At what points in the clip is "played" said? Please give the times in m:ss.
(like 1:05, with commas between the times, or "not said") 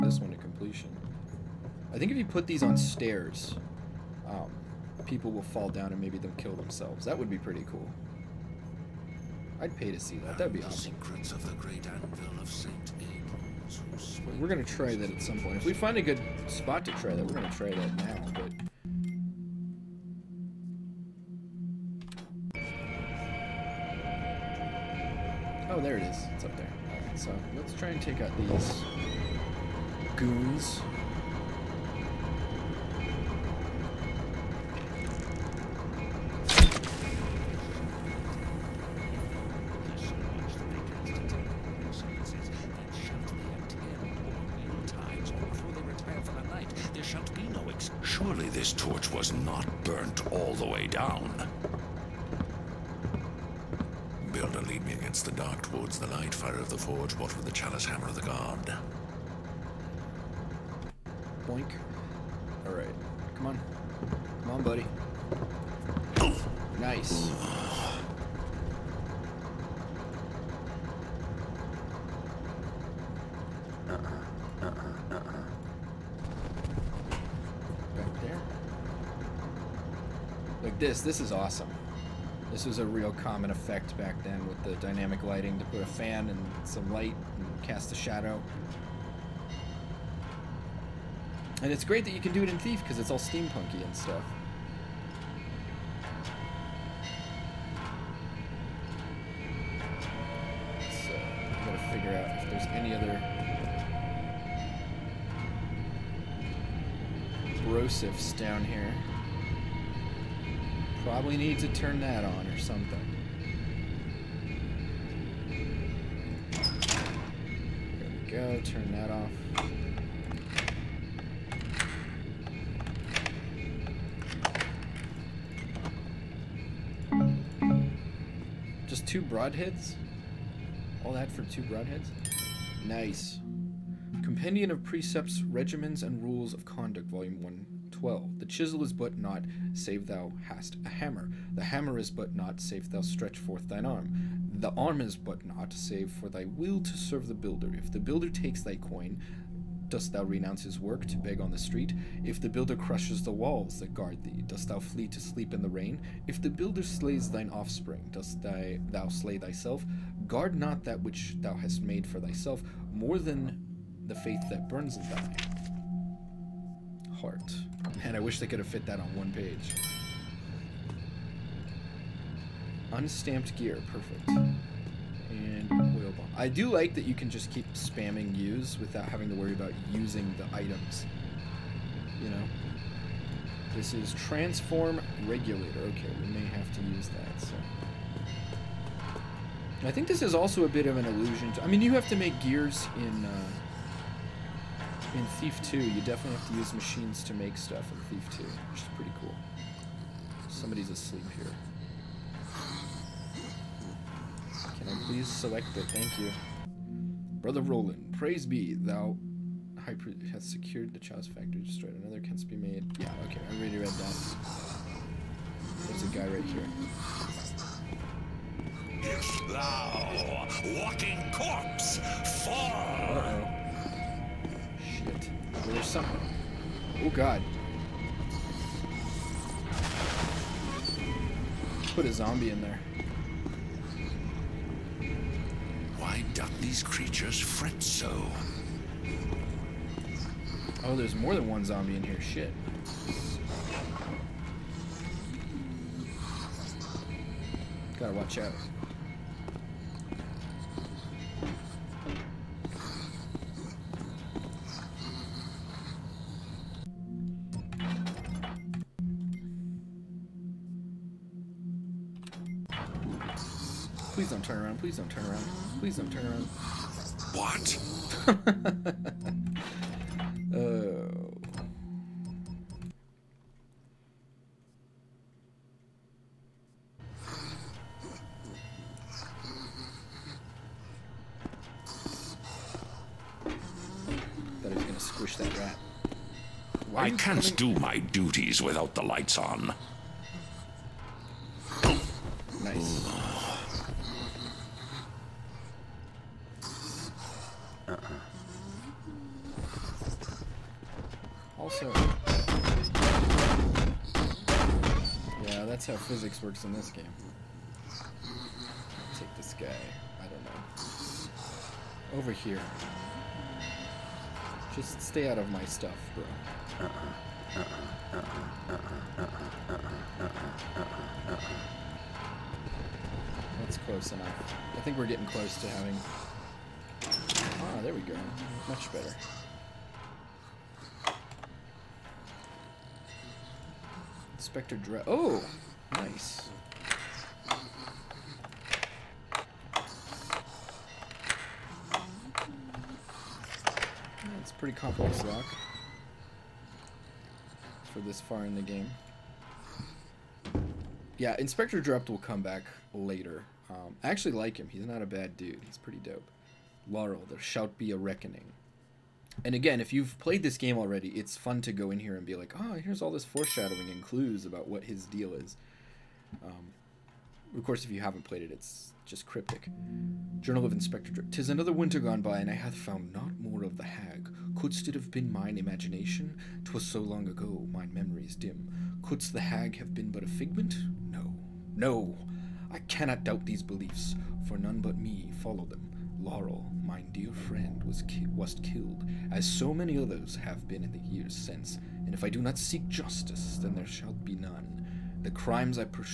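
6:00, 6:08.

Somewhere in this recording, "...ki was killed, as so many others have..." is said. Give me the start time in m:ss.
6:28.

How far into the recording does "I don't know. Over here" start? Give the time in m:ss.
5:10.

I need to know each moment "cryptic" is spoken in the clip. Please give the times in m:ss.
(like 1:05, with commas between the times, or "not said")
6:09.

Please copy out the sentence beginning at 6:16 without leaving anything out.
'Twas so long ago, mine memories dim.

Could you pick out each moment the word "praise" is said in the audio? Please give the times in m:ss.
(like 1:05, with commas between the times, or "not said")
3:28.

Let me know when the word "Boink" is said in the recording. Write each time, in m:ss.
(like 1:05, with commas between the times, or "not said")
1:01.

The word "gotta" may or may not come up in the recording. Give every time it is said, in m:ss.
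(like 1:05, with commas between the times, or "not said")
1:41, 4:07.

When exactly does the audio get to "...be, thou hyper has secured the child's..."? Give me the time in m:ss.
3:28.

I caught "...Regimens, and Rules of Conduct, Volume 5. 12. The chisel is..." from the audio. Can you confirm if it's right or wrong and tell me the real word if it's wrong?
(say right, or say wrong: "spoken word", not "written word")
wrong: "1", not "5".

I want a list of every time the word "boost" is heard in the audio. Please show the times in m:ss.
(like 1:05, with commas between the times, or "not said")
not said.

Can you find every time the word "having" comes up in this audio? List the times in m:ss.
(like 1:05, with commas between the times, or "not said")
2:59, 5:25.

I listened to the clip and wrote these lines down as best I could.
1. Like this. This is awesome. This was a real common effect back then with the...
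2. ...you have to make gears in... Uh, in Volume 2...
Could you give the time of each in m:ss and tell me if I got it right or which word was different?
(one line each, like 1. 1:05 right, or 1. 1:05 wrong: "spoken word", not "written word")
1. 1:20 right
2. 3:11 wrong: "Thief", not "Volume".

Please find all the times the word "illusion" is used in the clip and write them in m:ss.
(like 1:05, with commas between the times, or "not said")
3:11.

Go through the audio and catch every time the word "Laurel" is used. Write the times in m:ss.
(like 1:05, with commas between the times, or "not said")
5:56, 6:26.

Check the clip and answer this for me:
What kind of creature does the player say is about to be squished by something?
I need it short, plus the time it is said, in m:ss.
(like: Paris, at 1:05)
Rat, at 4:45.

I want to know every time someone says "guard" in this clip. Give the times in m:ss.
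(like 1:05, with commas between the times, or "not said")
2:33, 2:40.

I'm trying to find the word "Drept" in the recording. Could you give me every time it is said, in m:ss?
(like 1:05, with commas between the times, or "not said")
5:34, 5:51, 6:11.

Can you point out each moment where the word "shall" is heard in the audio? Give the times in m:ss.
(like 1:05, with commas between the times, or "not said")
5:57, 6:33.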